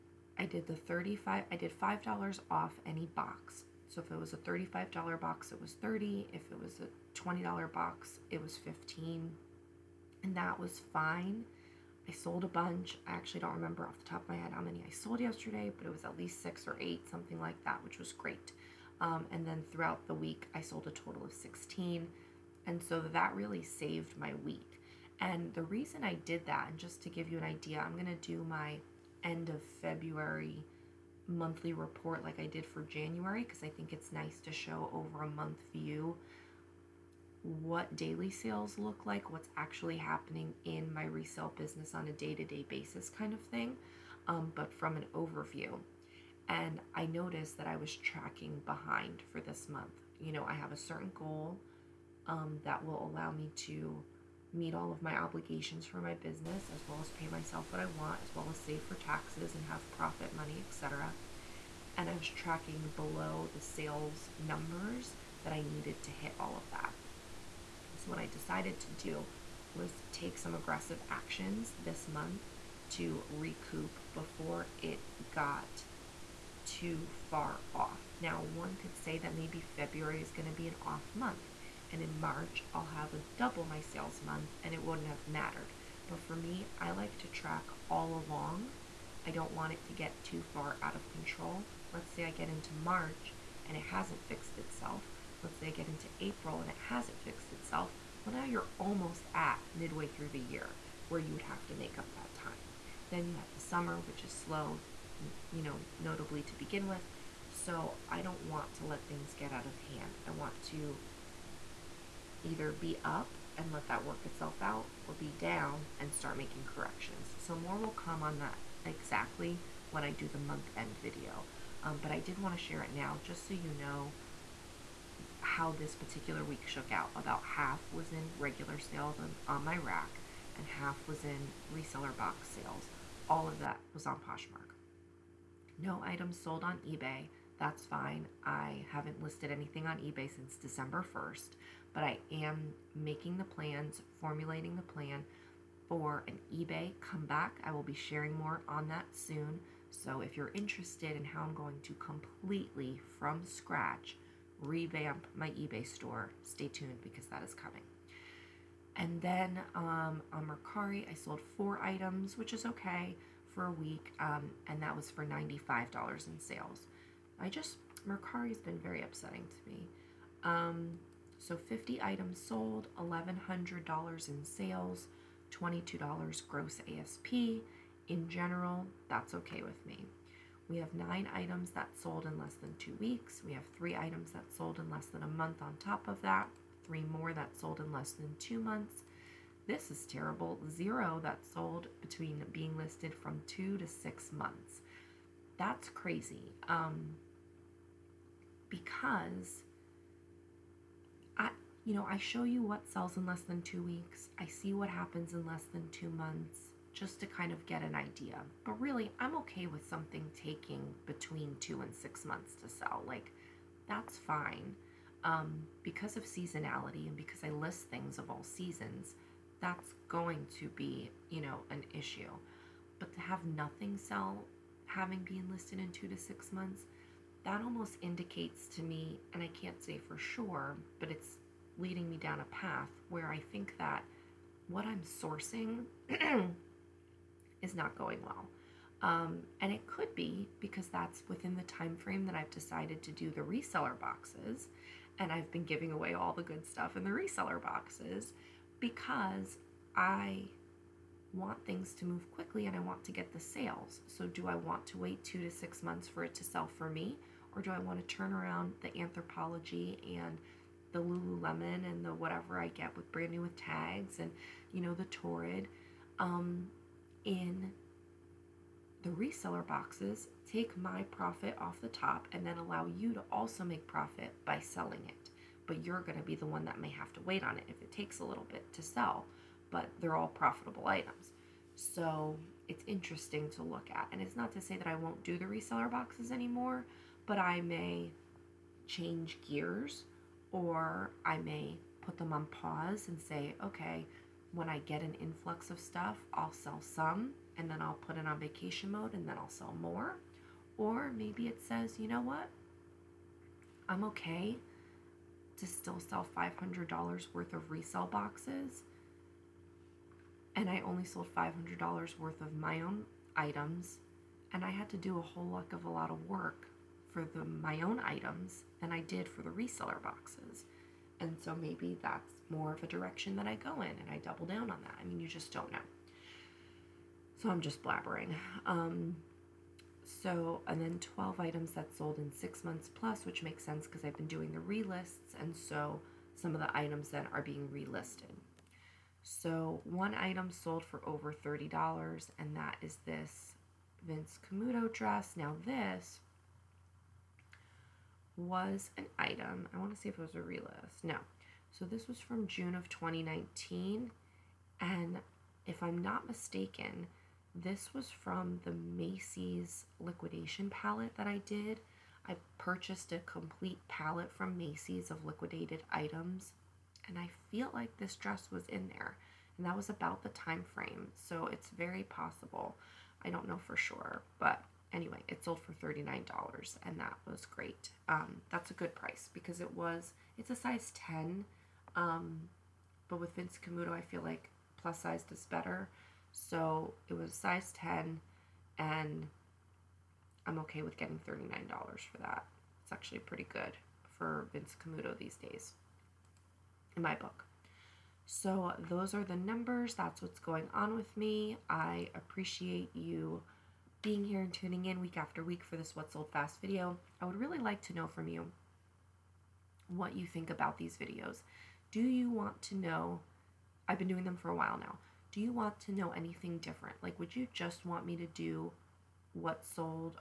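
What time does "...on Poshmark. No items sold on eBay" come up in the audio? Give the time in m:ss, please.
2:14.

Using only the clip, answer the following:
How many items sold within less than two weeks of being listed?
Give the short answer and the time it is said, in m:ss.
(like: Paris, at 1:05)
9, at 3:00.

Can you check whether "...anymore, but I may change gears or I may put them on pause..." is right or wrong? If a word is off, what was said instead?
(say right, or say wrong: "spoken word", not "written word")
right.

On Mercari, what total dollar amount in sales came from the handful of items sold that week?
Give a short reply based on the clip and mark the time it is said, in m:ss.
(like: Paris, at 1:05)
$95, at 2:45.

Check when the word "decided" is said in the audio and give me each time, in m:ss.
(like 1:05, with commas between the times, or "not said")
1:08, 4:02.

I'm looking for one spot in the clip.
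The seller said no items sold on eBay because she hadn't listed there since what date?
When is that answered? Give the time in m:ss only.
2:20.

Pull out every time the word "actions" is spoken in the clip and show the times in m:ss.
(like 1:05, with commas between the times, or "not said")
1:11.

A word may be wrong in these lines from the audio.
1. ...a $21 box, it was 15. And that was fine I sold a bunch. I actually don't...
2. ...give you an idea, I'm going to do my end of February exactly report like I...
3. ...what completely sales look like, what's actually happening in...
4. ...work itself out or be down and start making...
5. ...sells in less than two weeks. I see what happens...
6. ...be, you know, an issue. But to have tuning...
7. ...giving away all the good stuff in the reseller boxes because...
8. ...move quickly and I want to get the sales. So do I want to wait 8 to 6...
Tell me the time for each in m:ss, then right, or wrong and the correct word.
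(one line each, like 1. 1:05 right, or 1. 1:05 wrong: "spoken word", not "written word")
1. 0:06 wrong: "20", not "21"
2. 0:27 wrong: "monthly", not "exactly"
3. 0:37 wrong: "daily", not "completely"
4. 1:54 right
5. 3:22 right
6. 3:40 wrong: "nothing", not "tuning"
7. 4:05 right
8. 4:12 wrong: "2", not "8".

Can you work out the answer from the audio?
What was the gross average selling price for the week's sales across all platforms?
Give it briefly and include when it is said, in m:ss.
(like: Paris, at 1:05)
$22, at 2:55.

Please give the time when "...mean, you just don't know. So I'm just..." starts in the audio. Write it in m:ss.
5:25.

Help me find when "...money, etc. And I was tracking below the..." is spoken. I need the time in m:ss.
1:00.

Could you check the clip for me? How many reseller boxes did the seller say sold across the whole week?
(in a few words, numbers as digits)
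16.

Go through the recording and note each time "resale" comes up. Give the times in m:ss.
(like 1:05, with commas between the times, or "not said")
0:41, 5:07.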